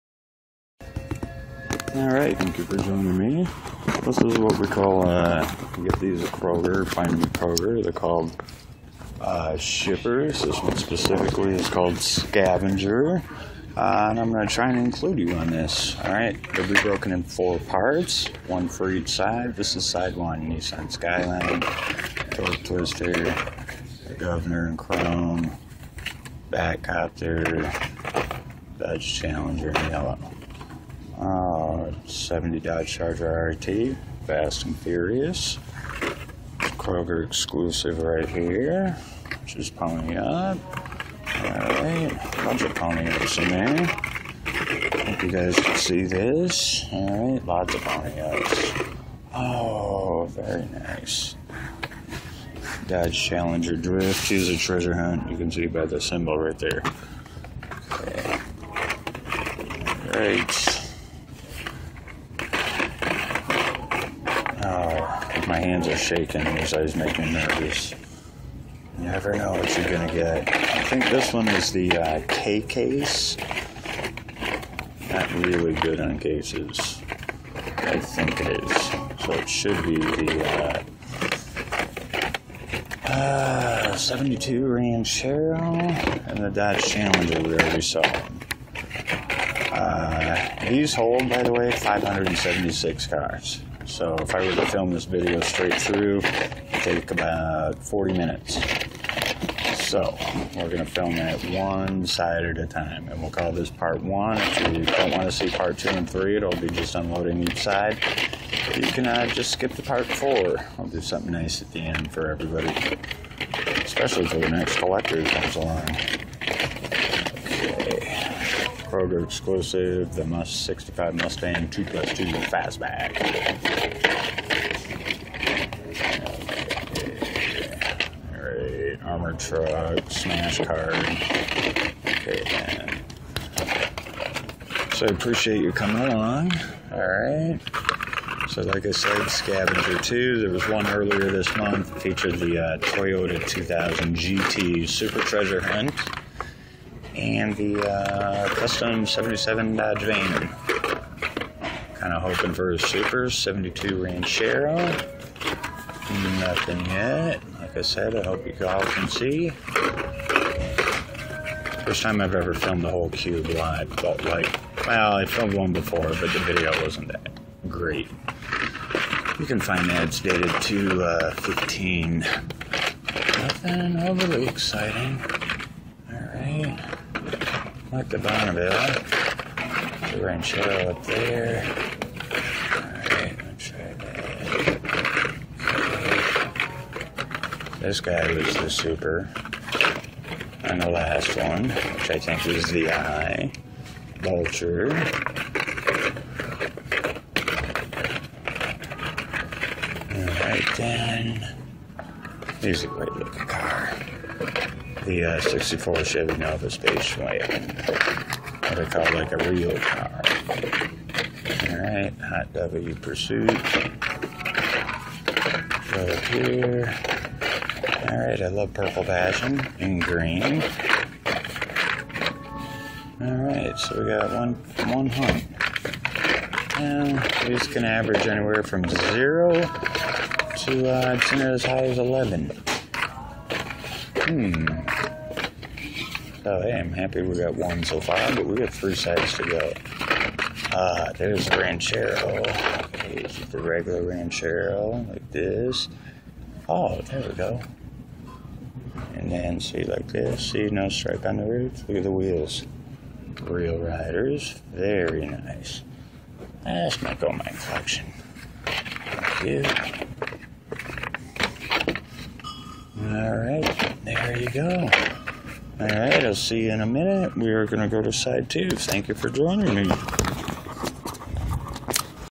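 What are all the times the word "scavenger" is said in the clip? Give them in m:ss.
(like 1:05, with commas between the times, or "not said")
0:11, 2:19.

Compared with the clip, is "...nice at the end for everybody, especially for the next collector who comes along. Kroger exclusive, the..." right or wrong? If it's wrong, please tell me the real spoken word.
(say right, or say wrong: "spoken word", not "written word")
right.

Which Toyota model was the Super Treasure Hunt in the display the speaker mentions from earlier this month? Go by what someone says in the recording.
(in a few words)
Toyota 2000 GT.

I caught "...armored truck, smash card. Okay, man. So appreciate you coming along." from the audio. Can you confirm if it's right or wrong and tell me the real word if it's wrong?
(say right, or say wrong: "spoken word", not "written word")
right.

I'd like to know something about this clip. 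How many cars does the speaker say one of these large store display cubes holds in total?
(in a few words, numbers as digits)
576.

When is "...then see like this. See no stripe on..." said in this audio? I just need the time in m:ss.
4:09.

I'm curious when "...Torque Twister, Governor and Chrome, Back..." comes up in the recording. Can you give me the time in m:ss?
0:22.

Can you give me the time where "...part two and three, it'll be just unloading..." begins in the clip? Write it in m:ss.
1:45.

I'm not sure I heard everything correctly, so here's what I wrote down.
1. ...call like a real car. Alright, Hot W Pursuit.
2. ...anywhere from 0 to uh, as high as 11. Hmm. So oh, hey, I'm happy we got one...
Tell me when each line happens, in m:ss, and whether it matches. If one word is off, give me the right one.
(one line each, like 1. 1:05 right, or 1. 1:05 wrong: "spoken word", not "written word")
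1. 3:28 right
2. 3:48 right.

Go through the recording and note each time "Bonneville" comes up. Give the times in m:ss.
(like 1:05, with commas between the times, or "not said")
2:58.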